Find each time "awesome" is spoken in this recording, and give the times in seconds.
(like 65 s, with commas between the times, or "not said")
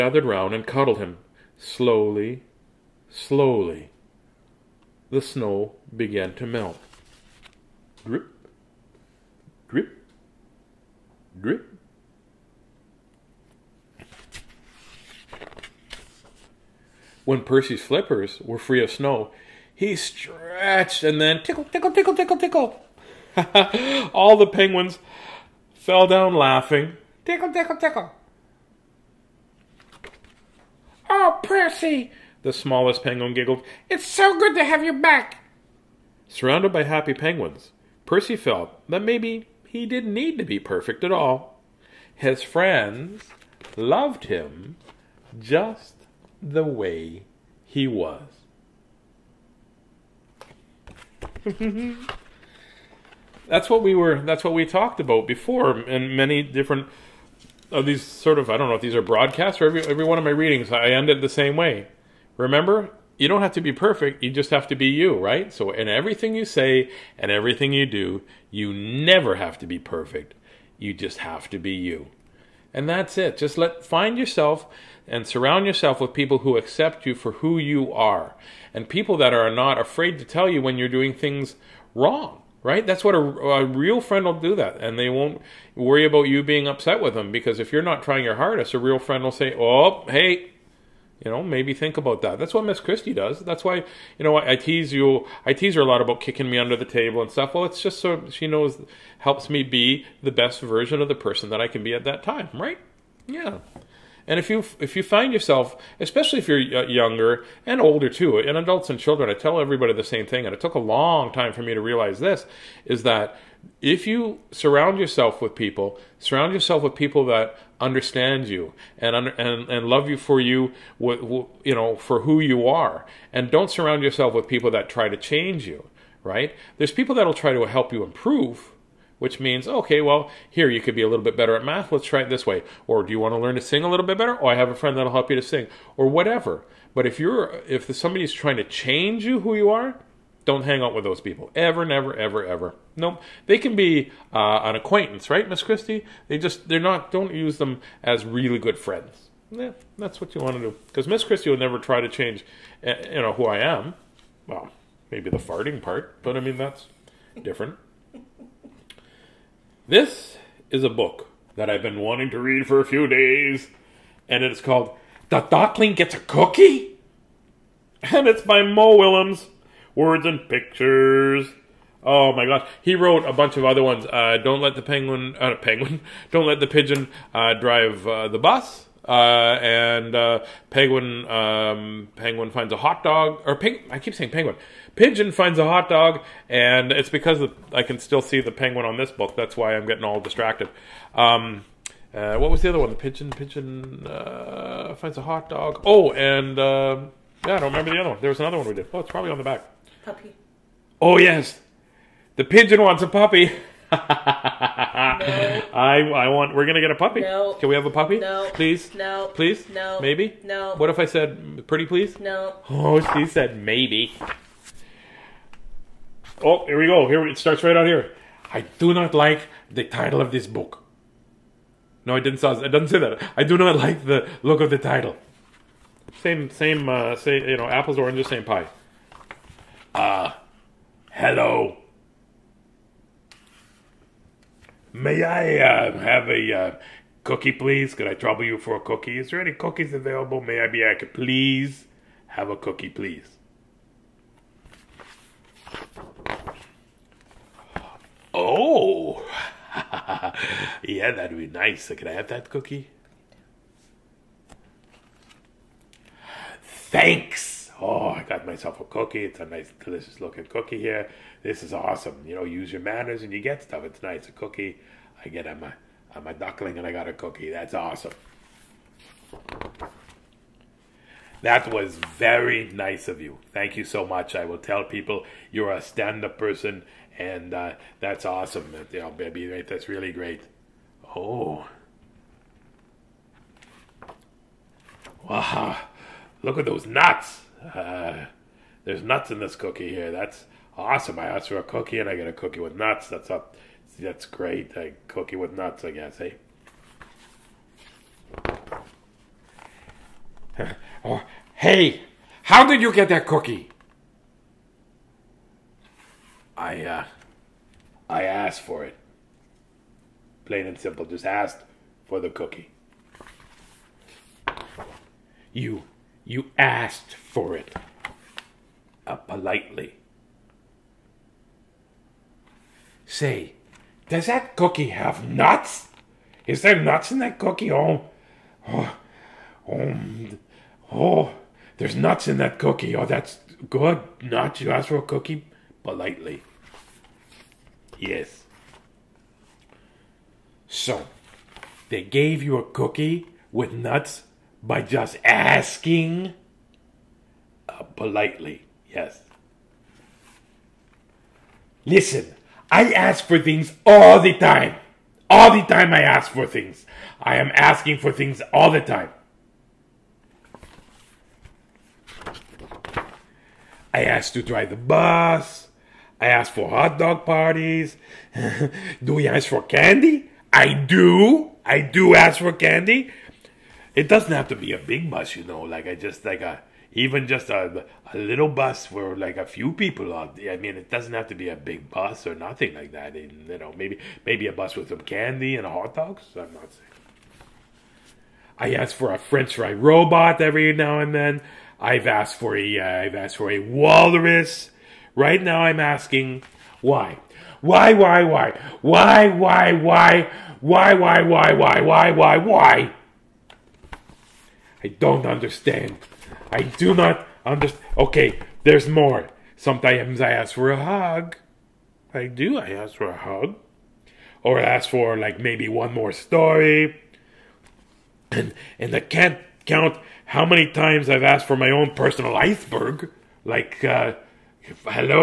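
261 s, 267 s, 278 s, 290 s.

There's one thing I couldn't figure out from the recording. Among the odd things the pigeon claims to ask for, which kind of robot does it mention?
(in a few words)
French fry robot.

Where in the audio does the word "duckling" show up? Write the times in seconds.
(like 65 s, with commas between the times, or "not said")
165 s, 266 s.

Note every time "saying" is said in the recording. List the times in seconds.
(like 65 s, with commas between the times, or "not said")
184 s, 386 s.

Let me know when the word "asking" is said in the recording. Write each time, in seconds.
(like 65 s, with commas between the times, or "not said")
345 s, 357 s, 395 s.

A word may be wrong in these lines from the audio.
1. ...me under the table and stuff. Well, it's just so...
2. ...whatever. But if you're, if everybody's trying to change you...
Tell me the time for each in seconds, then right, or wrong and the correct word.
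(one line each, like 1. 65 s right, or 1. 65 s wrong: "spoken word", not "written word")
1. 96 s right
2. 136 s wrong: "somebody", not "everybody".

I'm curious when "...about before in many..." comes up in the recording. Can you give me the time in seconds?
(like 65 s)
54 s.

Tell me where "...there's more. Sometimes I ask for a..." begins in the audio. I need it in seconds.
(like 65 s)
408 s.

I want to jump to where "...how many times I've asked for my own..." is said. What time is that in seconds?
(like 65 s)
420 s.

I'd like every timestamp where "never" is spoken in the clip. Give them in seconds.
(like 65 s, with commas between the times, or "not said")
68 s, 141 s, 151 s.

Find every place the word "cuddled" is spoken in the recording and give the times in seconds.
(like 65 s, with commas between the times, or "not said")
0 s.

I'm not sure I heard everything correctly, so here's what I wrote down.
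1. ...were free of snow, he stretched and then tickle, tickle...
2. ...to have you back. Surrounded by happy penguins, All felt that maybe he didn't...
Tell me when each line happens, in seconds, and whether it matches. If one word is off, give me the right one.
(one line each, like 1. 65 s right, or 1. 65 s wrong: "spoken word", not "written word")
1. 18 s right
2. 34 s wrong: "Percy", not "All".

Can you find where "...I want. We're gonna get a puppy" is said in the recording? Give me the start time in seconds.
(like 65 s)
205 s.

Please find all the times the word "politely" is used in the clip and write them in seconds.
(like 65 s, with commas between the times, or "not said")
319 s, 335 s, 347 s.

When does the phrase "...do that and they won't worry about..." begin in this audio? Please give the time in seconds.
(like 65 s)
84 s.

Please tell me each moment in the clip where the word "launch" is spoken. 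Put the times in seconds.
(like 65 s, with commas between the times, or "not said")
not said.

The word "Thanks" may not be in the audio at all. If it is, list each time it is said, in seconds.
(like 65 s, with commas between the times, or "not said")
256 s, 273 s.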